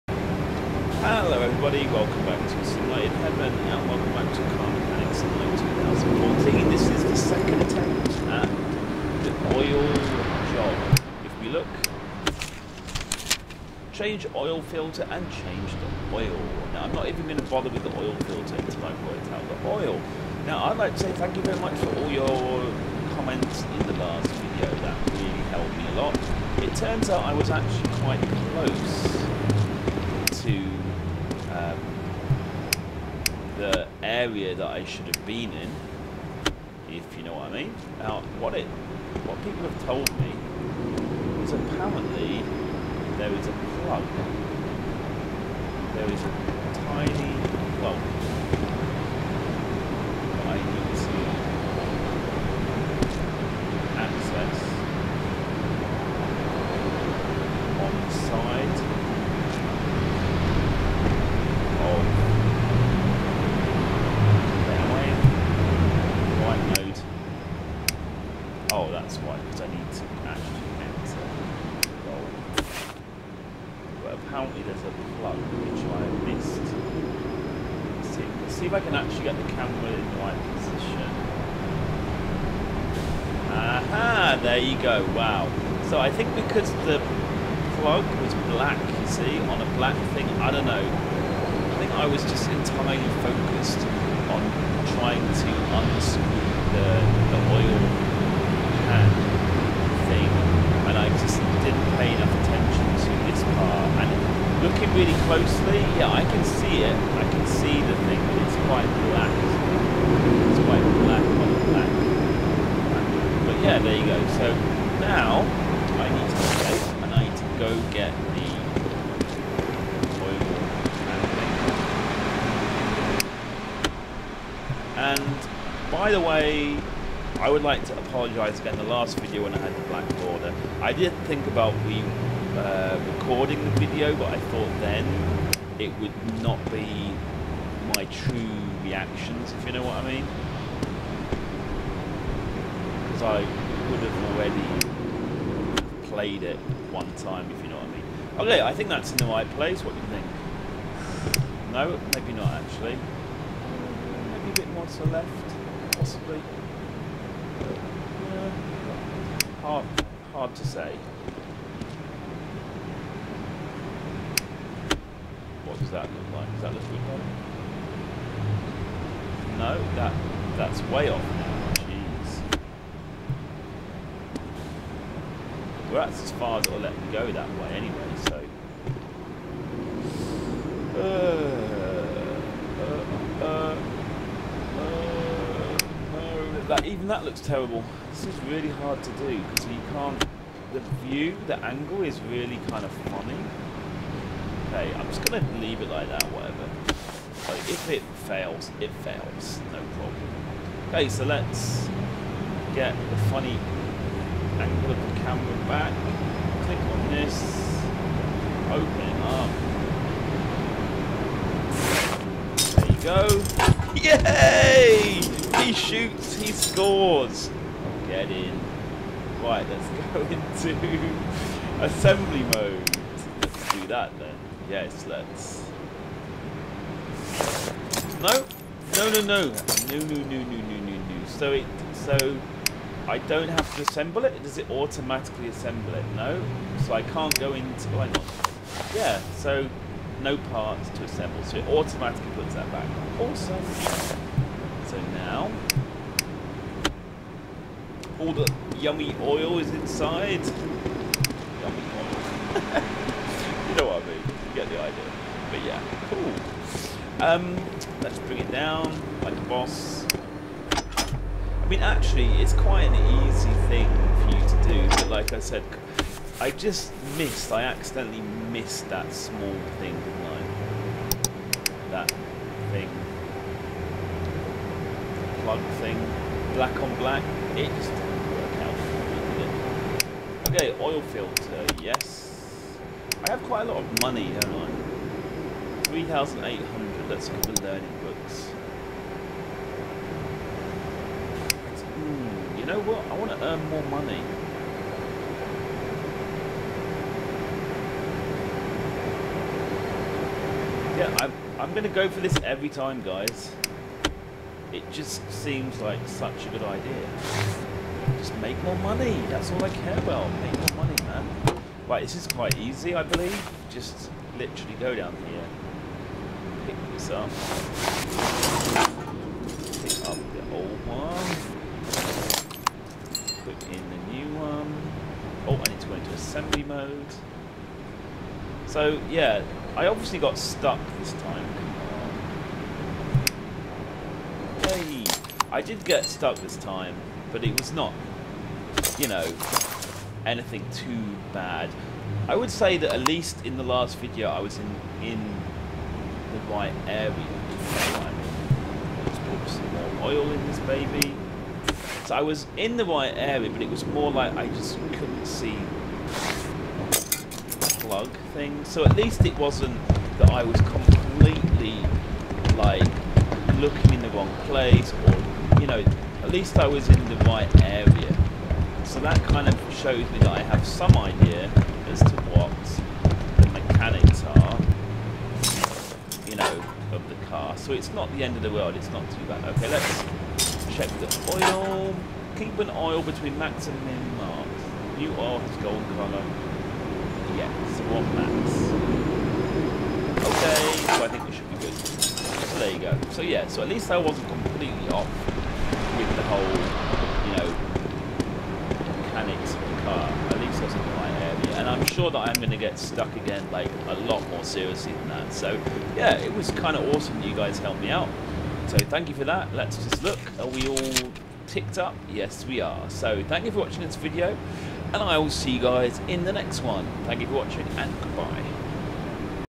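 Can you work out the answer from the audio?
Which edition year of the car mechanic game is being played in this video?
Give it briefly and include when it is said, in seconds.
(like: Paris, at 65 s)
2014, at 5 s.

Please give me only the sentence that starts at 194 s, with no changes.
I'm just going to leave it like that, whatever.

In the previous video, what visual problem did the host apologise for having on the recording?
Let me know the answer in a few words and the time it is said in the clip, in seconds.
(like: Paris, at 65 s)
black border, at 129 s.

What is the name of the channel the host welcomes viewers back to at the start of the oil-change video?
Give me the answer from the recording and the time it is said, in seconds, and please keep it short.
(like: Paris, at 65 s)
Simulated Heaven, at 2 s.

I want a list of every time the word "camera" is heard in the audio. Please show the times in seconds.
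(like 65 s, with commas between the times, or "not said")
79 s, 205 s.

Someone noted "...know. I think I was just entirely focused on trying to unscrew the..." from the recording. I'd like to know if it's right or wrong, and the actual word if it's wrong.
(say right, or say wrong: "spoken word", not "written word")
right.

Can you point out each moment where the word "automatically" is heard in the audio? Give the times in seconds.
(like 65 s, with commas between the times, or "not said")
234 s, 241 s.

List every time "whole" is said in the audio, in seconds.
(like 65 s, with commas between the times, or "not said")
396 s.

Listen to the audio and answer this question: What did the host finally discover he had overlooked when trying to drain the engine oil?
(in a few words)
a plug.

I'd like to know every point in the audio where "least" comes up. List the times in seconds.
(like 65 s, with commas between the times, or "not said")
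343 s, 358 s, 366 s, 393 s.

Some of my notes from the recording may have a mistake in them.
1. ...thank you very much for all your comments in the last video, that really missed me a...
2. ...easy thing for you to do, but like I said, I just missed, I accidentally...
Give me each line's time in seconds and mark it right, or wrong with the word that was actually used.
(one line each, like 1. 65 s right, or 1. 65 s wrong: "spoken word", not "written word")
1. 21 s wrong: "helped", not "missed"
2. 263 s right.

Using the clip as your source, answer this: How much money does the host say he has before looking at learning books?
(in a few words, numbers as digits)
3,800.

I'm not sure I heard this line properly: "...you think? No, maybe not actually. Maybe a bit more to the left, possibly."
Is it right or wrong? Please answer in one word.
right.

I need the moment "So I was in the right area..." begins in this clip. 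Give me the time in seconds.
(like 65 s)
352 s.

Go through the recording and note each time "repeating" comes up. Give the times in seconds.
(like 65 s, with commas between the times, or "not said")
not said.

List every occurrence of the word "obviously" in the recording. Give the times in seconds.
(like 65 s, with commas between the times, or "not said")
329 s, 349 s.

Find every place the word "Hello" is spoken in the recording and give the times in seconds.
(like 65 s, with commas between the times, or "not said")
1 s.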